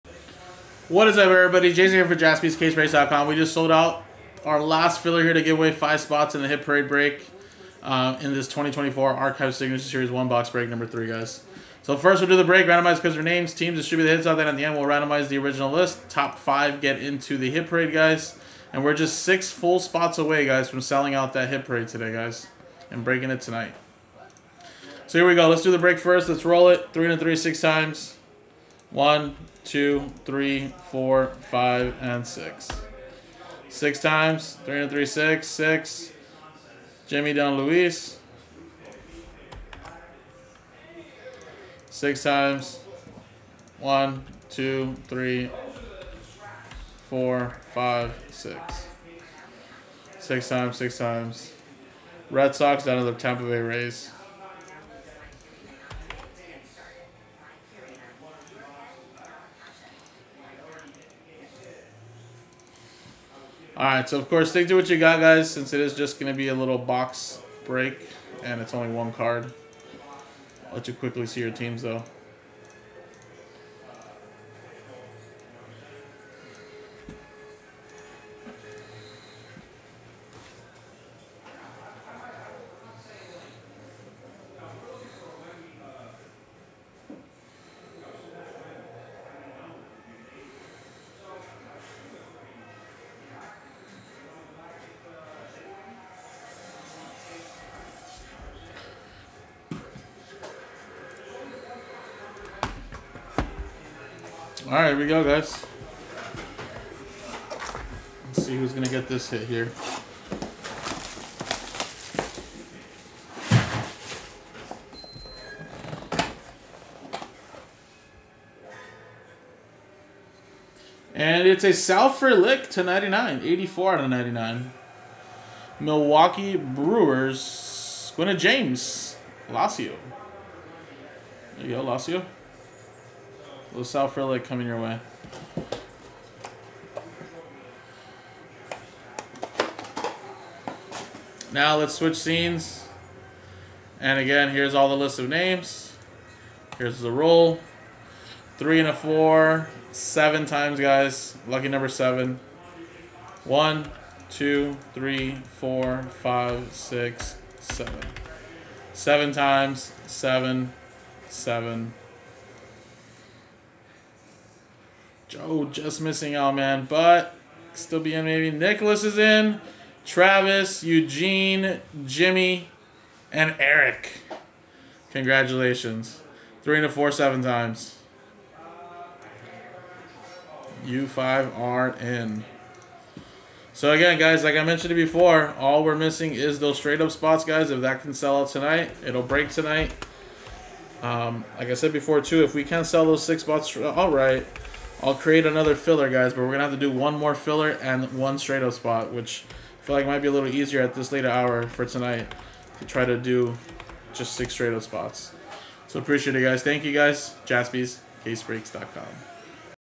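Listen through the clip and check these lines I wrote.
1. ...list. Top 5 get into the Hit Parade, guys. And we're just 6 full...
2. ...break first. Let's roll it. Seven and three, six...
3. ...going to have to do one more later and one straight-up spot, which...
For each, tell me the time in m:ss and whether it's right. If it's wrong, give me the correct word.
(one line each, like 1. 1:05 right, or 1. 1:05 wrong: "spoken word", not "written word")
1. 0:15 right
2. 0:25 wrong: "Three", not "Seven"
3. 3:16 wrong: "filler", not "later".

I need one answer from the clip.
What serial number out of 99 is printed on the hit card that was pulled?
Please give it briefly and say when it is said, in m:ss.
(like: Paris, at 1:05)
84, at 2:03.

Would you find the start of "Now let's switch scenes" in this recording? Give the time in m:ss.
2:21.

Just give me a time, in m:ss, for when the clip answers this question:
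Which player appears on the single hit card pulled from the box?
2:01.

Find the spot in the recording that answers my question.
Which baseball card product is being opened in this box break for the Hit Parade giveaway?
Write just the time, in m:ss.
0:08.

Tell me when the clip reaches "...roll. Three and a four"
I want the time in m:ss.
2:27.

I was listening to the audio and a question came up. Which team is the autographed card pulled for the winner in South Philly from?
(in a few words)
Milwaukee Brewers.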